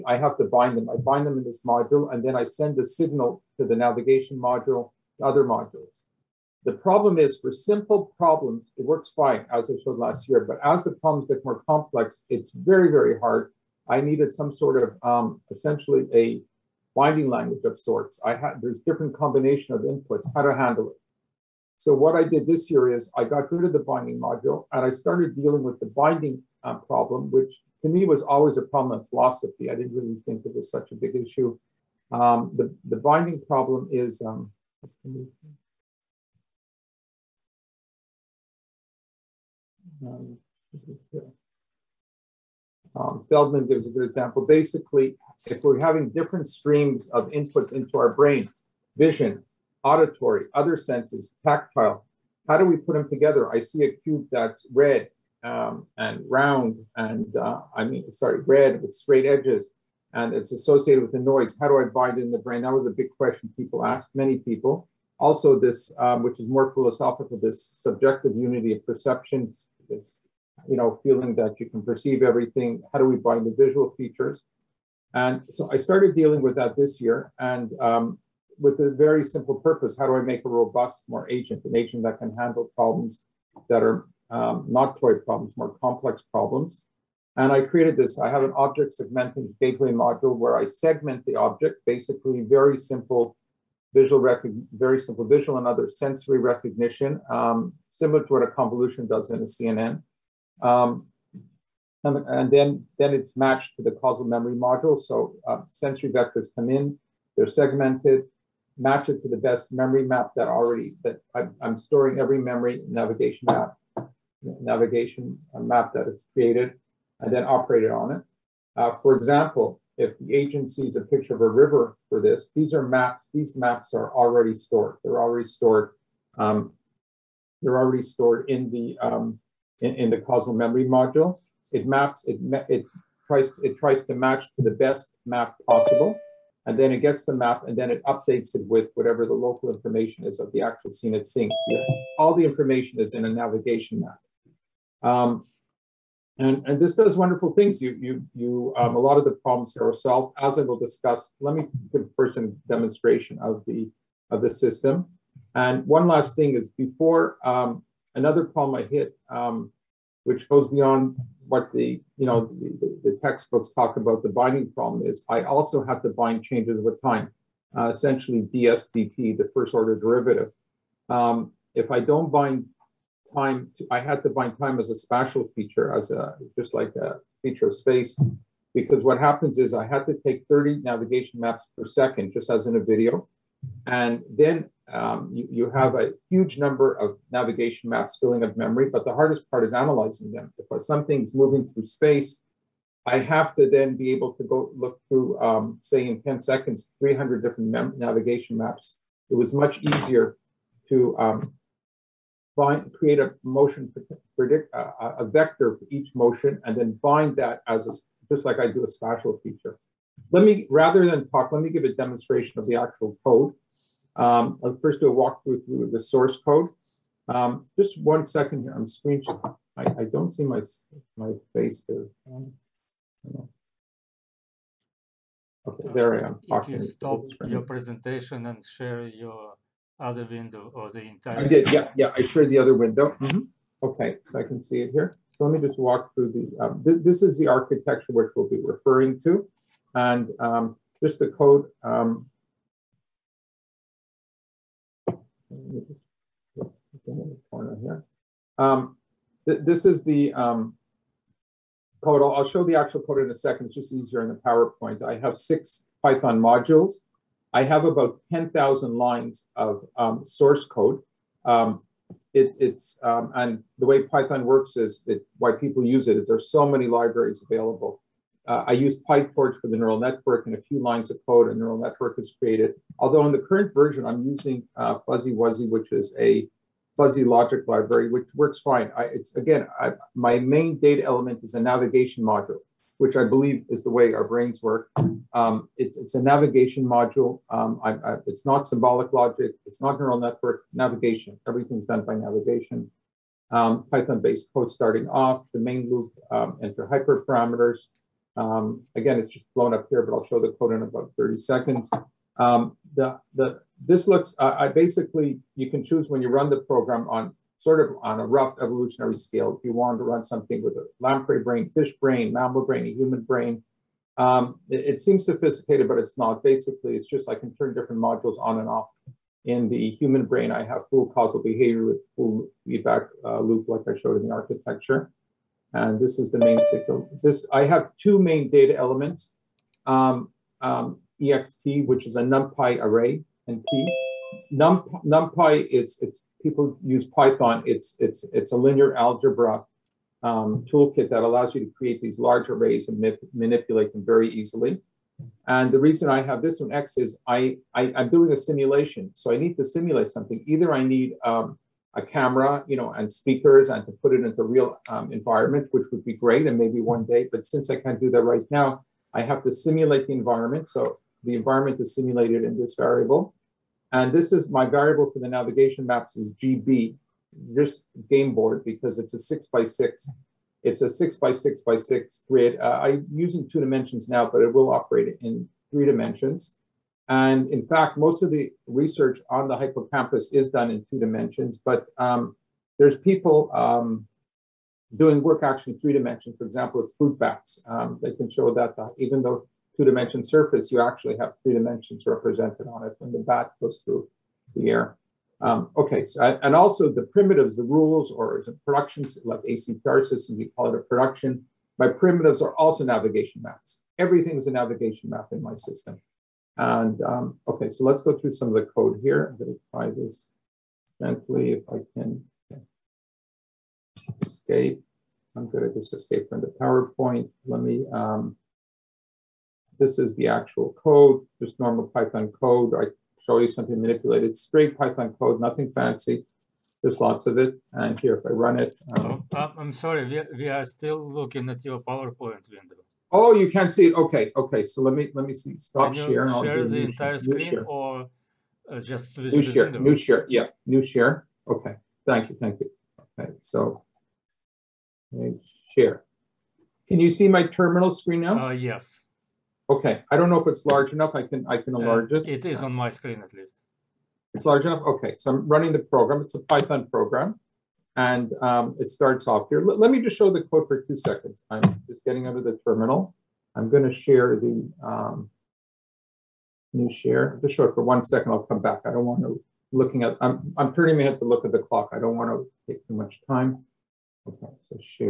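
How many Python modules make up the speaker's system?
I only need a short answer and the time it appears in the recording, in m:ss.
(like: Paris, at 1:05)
6, at 4:15.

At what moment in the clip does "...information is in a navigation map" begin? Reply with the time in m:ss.
2:22.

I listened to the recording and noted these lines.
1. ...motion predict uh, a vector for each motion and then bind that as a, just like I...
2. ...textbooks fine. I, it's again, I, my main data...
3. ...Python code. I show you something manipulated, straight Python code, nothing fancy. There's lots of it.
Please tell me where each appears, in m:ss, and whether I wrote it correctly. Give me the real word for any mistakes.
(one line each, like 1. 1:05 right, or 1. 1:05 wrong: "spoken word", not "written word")
1. 3:23 right
2. 4:38 wrong: "works", not "textbooks"
3. 7:01 right.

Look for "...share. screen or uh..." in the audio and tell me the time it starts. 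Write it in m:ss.
7:17.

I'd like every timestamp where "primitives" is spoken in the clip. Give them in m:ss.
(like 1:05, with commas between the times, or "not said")
6:37, 6:41.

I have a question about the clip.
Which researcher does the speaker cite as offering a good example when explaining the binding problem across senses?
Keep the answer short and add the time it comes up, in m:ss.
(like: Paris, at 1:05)
Feldman, at 0:43.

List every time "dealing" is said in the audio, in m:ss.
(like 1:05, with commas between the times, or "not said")
0:25, 1:16.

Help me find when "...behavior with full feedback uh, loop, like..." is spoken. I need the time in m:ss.
5:21.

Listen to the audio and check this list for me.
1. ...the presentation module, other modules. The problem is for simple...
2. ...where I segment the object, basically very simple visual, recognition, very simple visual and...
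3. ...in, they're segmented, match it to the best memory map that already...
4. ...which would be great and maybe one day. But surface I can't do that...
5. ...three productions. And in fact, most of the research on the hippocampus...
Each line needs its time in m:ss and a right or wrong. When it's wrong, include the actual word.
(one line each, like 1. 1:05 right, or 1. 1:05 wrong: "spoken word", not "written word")
1. 0:03 wrong: "navigation", not "presentation"
2. 1:30 right
3. 1:46 right
4. 5:55 wrong: "since", not "surface"
5. 6:15 wrong: "dimensions", not "productions".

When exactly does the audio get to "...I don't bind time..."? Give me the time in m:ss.
2:51.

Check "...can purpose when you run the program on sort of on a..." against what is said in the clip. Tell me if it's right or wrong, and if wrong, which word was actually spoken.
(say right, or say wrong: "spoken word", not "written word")
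wrong: "choose", not "purpose".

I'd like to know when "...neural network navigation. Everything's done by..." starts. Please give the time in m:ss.
4:49.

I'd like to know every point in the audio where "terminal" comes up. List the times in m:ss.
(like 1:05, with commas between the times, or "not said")
7:27, 7:42.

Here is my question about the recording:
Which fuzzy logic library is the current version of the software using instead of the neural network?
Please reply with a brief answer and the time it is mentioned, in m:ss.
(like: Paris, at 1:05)
FuzzyWuzzy, at 4:34.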